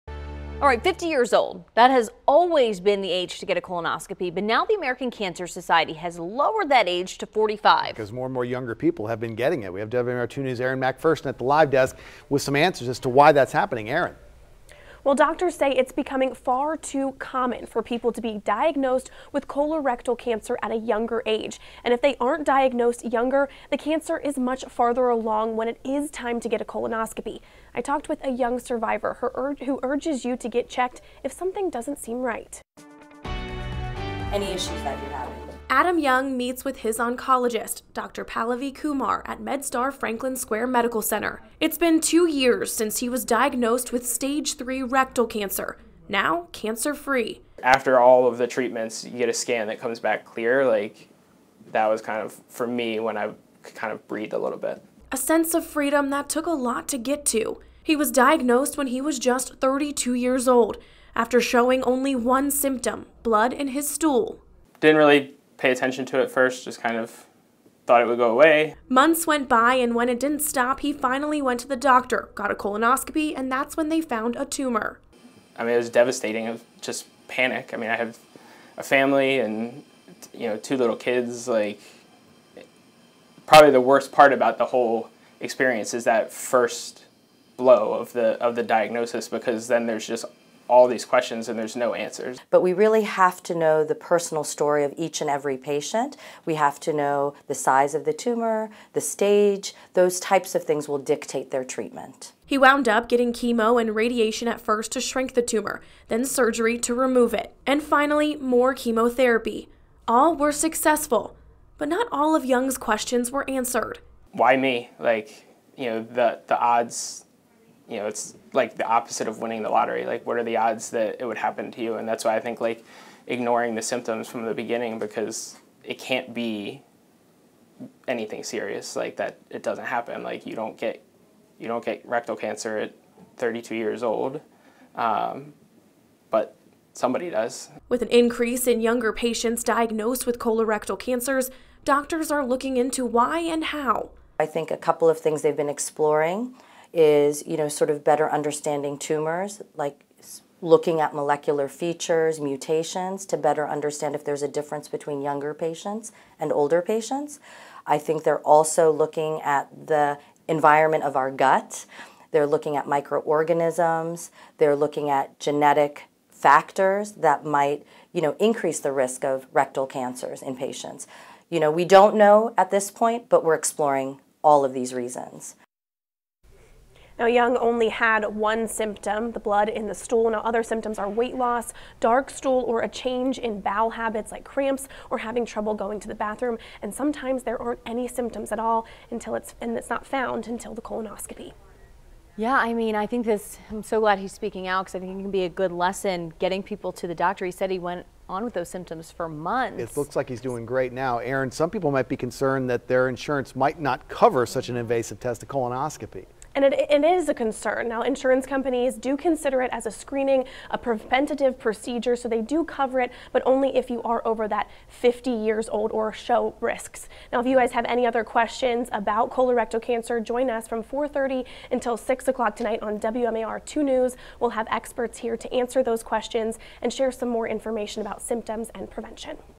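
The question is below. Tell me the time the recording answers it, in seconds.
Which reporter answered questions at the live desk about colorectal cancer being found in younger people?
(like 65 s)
10 s.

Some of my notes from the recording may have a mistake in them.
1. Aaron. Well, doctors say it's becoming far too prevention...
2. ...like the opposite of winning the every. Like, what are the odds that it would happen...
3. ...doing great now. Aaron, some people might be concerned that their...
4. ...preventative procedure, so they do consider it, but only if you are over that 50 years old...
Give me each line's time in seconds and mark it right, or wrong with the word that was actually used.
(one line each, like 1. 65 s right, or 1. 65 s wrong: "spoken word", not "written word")
1. 13 s wrong: "common", not "prevention"
2. 118 s wrong: "lottery", not "every"
3. 200 s right
4. 210 s wrong: "cover", not "consider".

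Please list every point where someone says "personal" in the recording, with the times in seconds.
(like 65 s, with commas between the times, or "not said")
93 s.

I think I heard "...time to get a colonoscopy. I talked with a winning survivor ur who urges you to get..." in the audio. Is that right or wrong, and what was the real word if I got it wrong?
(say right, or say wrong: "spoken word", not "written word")
wrong: "young", not "winning".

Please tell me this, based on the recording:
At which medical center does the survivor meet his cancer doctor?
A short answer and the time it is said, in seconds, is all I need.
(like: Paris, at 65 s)
MedStar Franklin Square Medical Center, at 39 s.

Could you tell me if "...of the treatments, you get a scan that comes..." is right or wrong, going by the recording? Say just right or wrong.
right.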